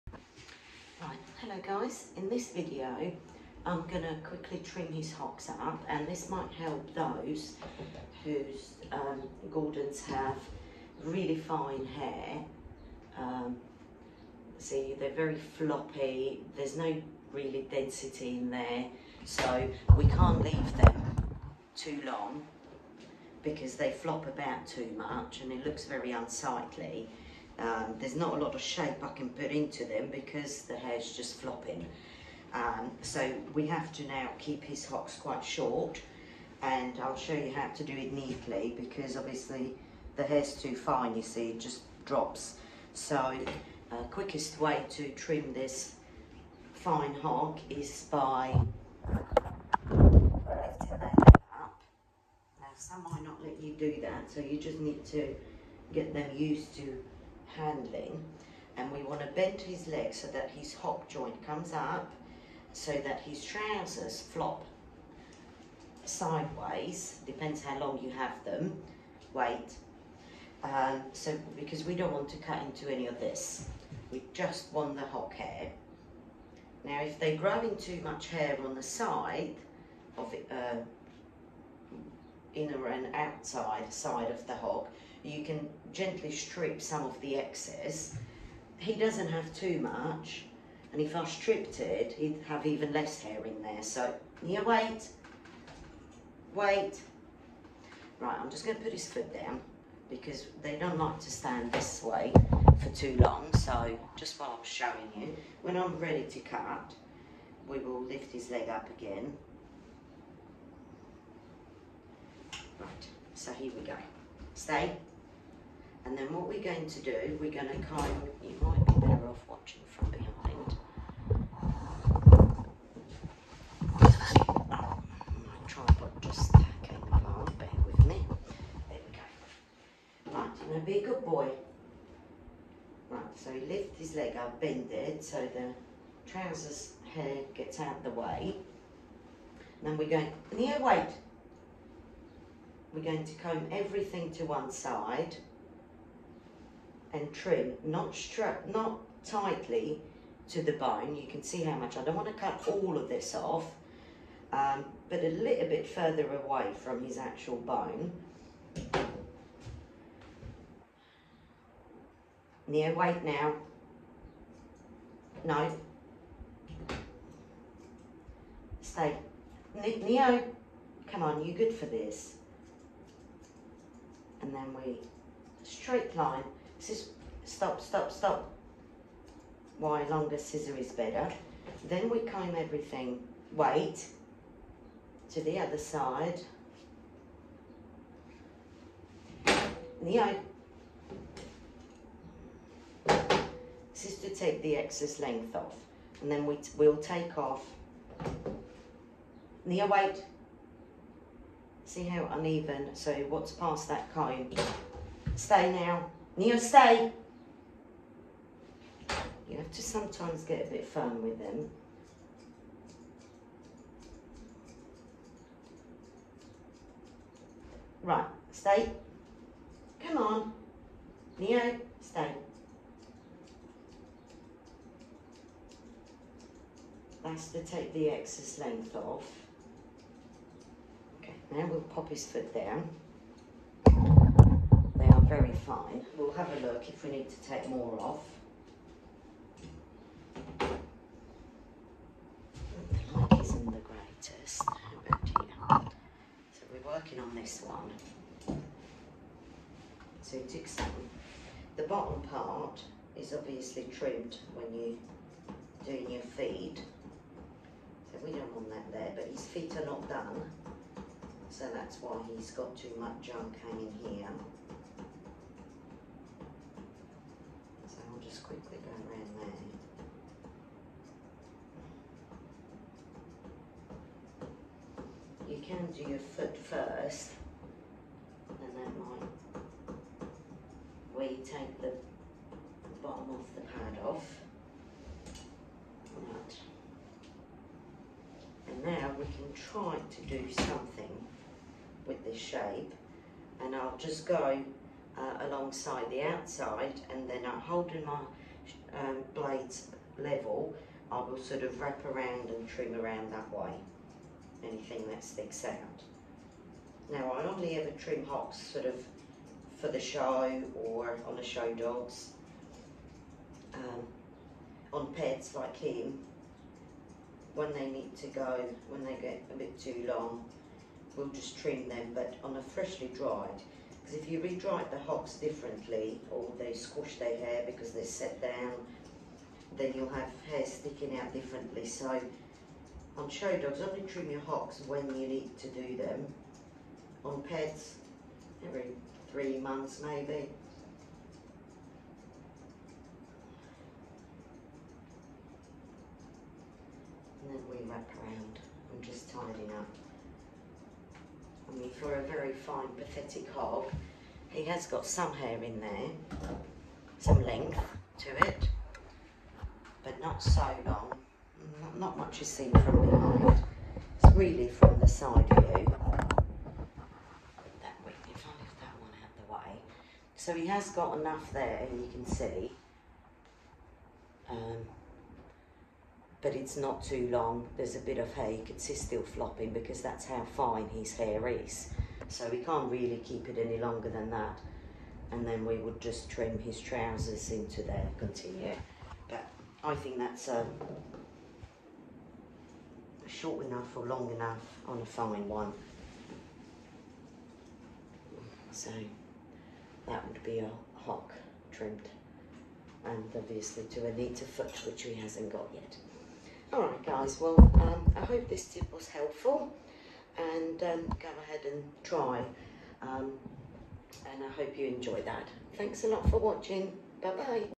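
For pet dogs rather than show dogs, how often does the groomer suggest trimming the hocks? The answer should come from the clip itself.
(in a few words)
Every 3 months.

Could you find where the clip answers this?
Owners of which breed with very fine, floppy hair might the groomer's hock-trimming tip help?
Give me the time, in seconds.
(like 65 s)
9 s.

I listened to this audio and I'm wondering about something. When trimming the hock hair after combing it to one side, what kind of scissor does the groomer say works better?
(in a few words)
Longer scissor.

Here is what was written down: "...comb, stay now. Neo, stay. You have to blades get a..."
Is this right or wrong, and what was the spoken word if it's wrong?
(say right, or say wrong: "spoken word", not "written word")
wrong: "sometimes", not "blades".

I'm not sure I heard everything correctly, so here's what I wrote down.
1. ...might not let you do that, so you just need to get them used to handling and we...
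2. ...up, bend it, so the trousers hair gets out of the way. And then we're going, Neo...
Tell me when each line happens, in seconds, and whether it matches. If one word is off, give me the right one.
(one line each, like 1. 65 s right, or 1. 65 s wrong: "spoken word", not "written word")
1. 53 s right
2. 134 s right.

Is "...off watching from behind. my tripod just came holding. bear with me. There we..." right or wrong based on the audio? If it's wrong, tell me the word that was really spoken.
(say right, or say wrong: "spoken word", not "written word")
wrong: "along", not "holding".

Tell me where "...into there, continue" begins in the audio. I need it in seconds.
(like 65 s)
387 s.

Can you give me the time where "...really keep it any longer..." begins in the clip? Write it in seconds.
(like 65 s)
382 s.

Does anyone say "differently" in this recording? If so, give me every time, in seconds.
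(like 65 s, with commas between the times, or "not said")
325 s, 331 s.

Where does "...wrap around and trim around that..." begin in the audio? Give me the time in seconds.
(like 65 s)
301 s.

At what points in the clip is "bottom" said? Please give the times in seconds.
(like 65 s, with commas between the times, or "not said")
251 s, 283 s.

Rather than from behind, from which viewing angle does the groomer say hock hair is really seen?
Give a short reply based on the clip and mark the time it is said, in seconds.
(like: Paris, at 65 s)
Side view, at 365 s.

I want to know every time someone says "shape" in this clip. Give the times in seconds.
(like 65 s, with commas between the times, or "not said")
28 s, 292 s.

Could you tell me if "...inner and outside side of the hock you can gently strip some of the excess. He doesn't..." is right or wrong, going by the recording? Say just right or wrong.
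right.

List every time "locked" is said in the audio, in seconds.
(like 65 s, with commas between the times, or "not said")
not said.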